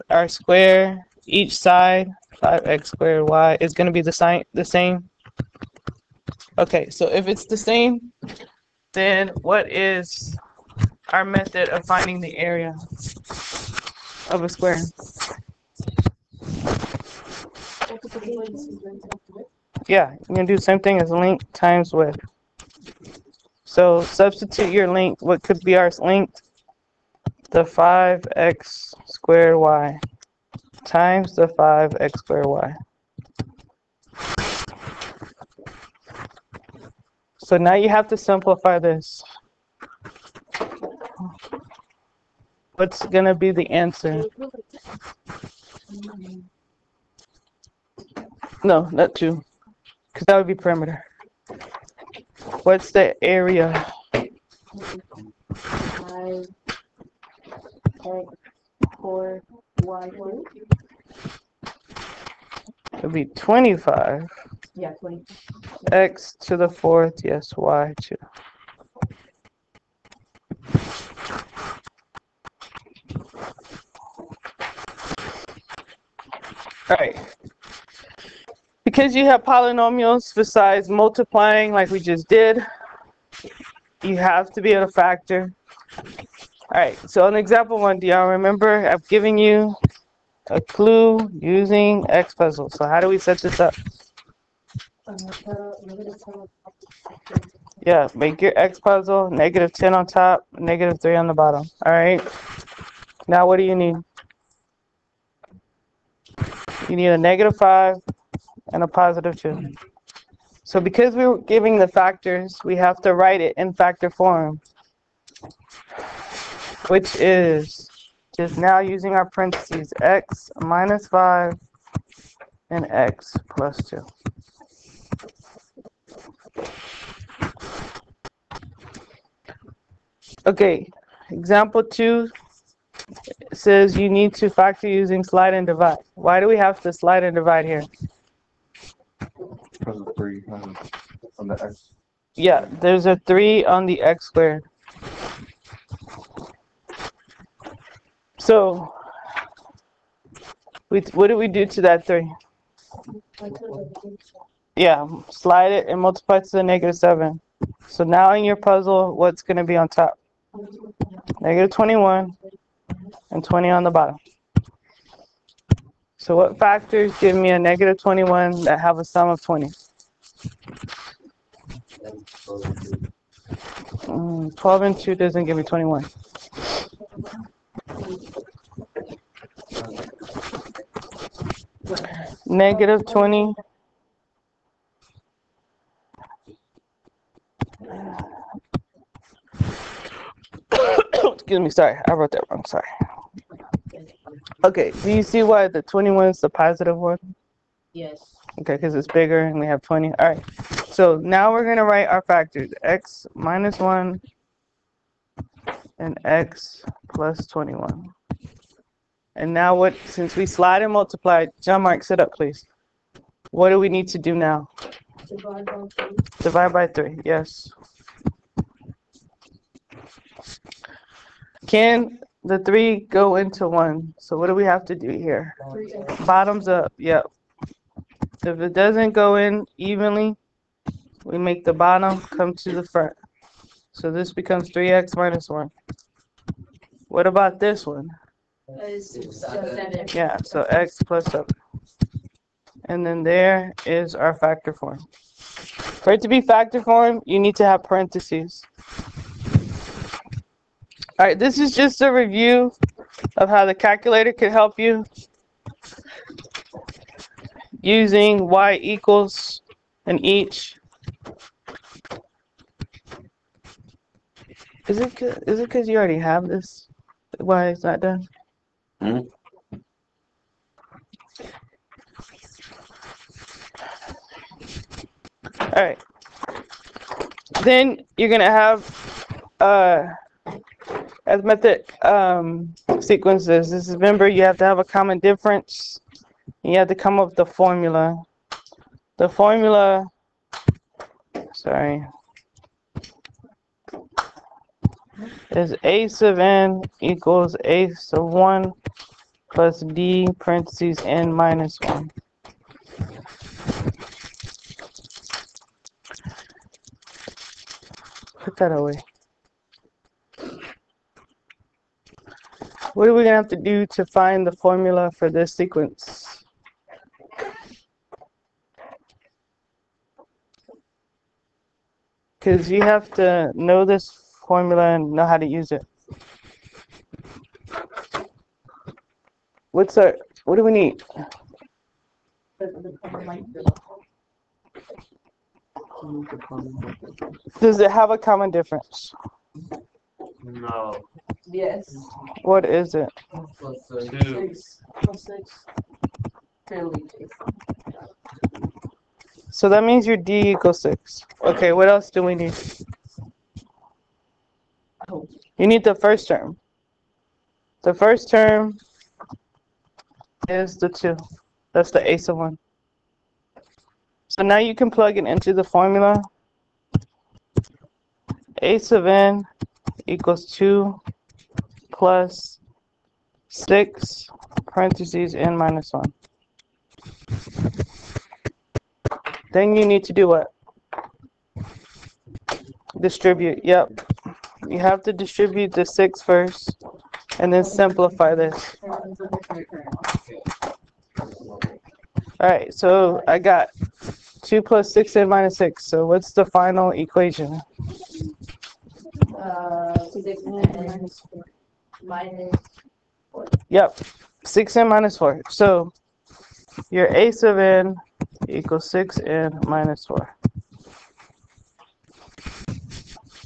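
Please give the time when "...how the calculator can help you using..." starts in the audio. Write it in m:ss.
4:13.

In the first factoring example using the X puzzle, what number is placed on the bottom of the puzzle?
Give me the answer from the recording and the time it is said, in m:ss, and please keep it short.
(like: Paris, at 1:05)
negative 3, at 1:40.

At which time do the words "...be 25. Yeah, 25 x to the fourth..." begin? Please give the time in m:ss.
1:03.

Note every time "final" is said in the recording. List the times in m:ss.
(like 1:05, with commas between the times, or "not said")
6:36.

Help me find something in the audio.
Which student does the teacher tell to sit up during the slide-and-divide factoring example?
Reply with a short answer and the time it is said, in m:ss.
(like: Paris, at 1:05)
John Mark, at 3:31.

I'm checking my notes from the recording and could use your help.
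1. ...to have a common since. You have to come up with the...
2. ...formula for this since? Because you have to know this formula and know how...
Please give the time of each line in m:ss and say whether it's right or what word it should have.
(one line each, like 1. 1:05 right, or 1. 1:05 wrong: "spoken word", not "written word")
1. 4:44 wrong: "difference", not "since"
2. 5:14 wrong: "sequence", not "since".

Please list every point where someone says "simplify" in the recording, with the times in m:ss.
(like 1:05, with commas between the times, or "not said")
0:38, 6:27.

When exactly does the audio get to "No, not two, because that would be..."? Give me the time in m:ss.
0:48.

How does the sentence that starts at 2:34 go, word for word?
Yeah, slide it and multiply to the negative 7.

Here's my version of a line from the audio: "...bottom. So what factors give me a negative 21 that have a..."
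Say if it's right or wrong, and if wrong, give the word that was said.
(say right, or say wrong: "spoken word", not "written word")
right.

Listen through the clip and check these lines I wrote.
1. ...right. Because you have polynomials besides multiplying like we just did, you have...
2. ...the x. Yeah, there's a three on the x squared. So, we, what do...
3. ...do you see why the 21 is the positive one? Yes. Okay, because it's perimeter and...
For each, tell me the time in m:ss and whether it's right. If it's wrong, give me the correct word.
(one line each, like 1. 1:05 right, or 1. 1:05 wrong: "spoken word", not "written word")
1. 1:16 right
2. 2:21 right
3. 3:15 wrong: "bigger", not "perimeter".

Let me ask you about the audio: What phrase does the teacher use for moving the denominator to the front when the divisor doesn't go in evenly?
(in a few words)
Bottoms up.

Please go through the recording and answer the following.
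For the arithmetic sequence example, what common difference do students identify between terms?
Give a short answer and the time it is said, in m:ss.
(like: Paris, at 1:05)
6, at 5:45.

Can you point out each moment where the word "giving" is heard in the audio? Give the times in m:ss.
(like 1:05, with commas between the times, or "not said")
1:51.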